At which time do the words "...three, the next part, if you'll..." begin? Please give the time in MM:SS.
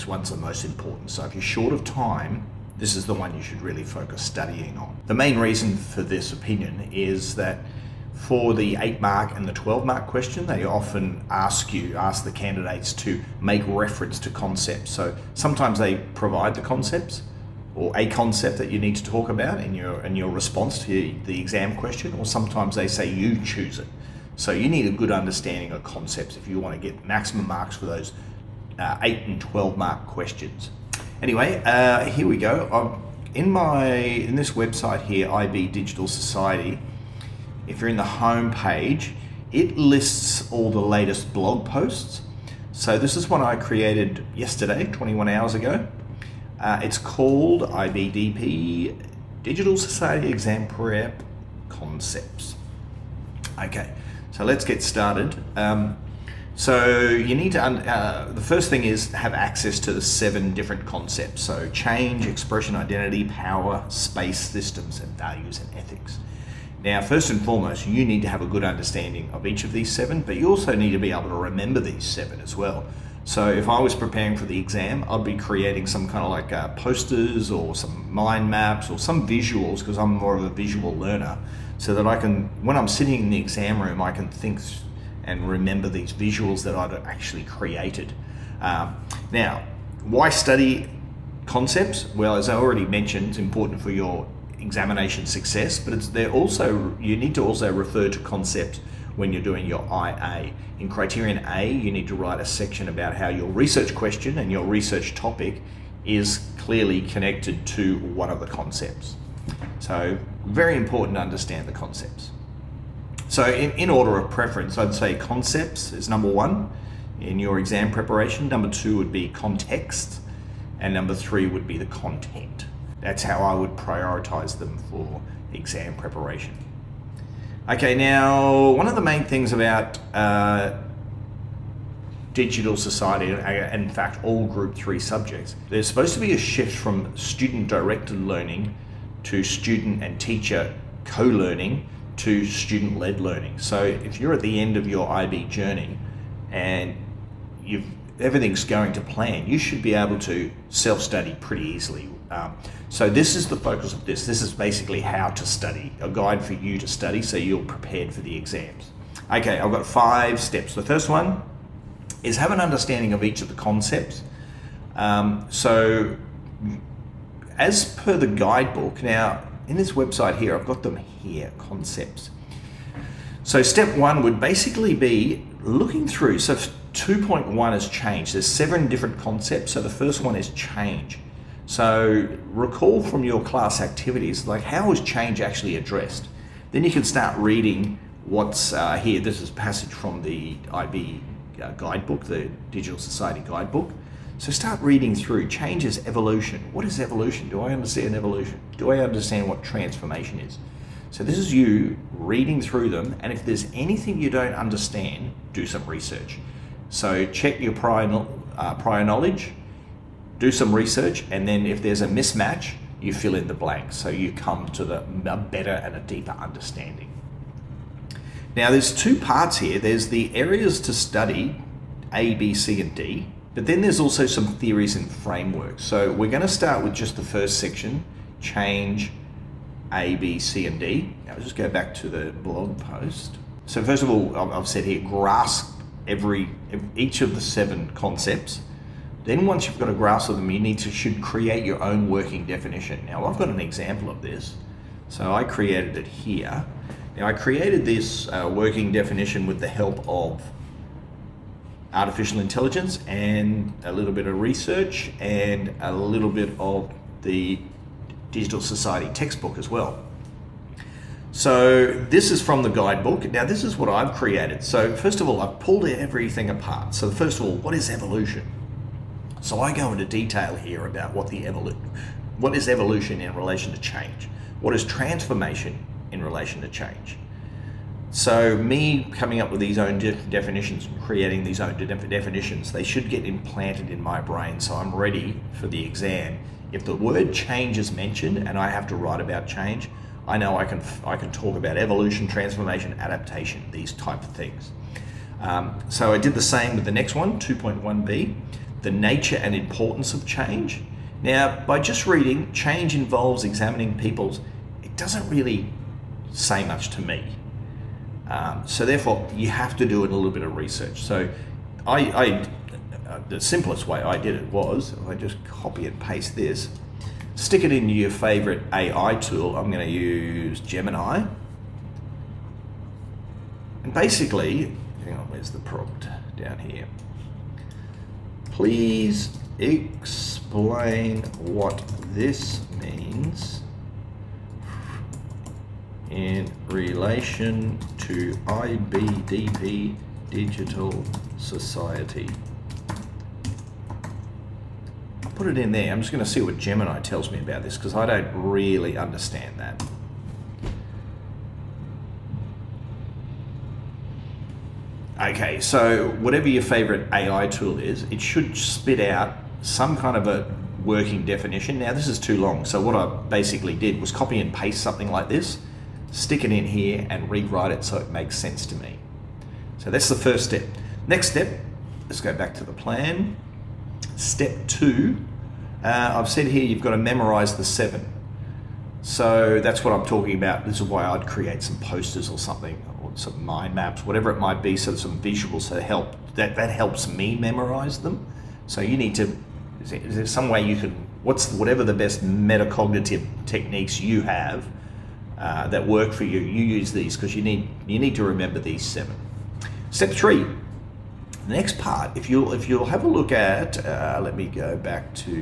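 06:40.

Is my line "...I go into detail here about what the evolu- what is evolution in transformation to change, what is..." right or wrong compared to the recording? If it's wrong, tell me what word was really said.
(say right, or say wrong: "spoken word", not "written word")
wrong: "relation", not "transformation".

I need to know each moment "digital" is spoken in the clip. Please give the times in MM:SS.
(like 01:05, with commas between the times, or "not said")
00:35, 00:49, 02:12, 03:12, 04:18, 05:40.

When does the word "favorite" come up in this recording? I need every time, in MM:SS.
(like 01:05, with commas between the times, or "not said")
05:18, 05:56.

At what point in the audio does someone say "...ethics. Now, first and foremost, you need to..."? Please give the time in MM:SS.
01:05.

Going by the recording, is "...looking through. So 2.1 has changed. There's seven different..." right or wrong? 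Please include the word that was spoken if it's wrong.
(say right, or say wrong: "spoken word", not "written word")
right.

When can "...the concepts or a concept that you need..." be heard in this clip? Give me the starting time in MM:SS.
00:16.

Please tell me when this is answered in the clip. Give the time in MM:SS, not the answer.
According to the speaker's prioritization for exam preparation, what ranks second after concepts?
01:58.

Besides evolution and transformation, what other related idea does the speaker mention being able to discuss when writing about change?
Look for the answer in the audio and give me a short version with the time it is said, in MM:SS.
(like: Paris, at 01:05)
Adaptation, at 04:52.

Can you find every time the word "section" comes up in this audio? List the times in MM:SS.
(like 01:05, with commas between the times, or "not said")
01:42, 03:47.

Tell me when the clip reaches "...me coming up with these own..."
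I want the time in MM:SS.
04:38.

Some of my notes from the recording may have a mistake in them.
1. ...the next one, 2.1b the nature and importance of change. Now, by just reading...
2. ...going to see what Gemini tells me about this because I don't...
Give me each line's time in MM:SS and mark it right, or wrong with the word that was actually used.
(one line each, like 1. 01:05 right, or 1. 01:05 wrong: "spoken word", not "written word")
1. 04:56 right
2. 05:46 right.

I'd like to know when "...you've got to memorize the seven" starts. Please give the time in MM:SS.
06:16.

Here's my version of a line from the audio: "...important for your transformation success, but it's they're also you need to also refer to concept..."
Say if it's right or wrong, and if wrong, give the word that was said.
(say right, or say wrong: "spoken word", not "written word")
wrong: "examination", not "transformation".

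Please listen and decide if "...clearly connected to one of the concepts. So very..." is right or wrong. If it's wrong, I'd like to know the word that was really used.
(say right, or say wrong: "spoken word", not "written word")
right.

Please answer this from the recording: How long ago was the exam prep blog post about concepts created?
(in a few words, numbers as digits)
21 hours.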